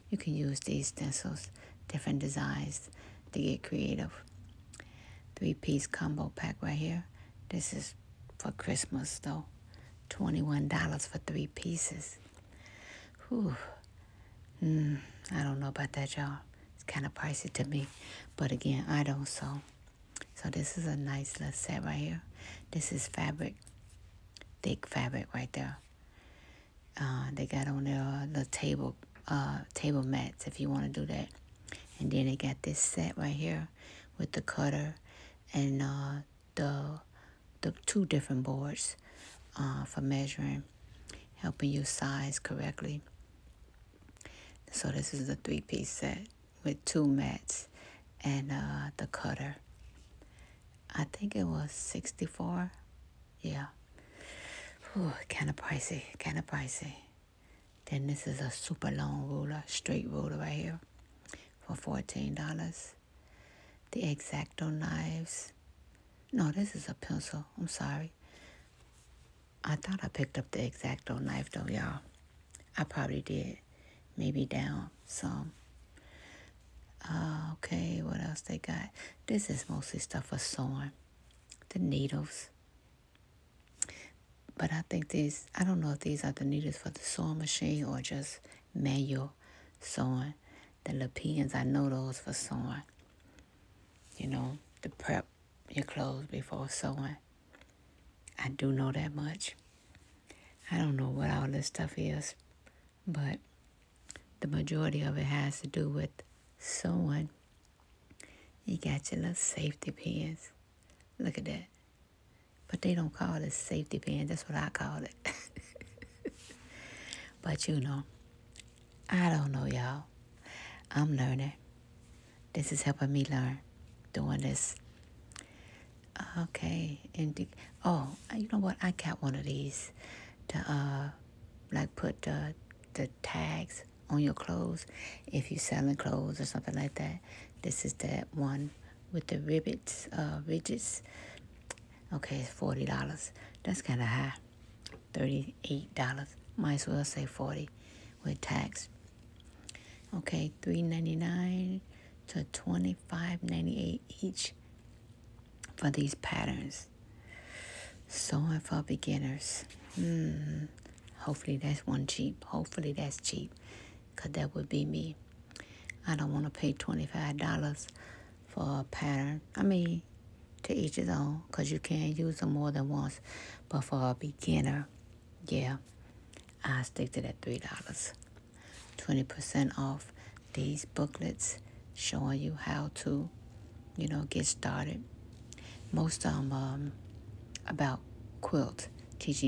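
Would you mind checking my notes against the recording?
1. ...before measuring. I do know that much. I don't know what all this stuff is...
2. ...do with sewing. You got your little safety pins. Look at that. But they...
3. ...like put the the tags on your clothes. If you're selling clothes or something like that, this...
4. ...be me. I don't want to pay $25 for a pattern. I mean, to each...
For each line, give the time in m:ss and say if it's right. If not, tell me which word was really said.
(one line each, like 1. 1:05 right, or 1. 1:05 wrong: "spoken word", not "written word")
1. 1:36 wrong: "sewing", not "measuring"
2. 1:45 right
3. 2:11 right
4. 2:44 right.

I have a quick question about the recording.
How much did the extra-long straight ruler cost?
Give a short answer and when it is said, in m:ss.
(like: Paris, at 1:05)
$14, at 1:02.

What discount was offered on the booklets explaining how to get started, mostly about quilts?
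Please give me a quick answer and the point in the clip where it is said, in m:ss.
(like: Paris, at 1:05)
20% off, at 2:58.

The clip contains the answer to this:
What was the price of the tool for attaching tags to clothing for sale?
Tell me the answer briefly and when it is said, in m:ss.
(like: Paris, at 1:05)
$38, at 2:25.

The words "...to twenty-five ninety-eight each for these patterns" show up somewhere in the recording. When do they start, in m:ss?
2:32.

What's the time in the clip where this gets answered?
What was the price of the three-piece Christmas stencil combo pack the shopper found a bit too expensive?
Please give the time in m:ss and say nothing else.
0:10.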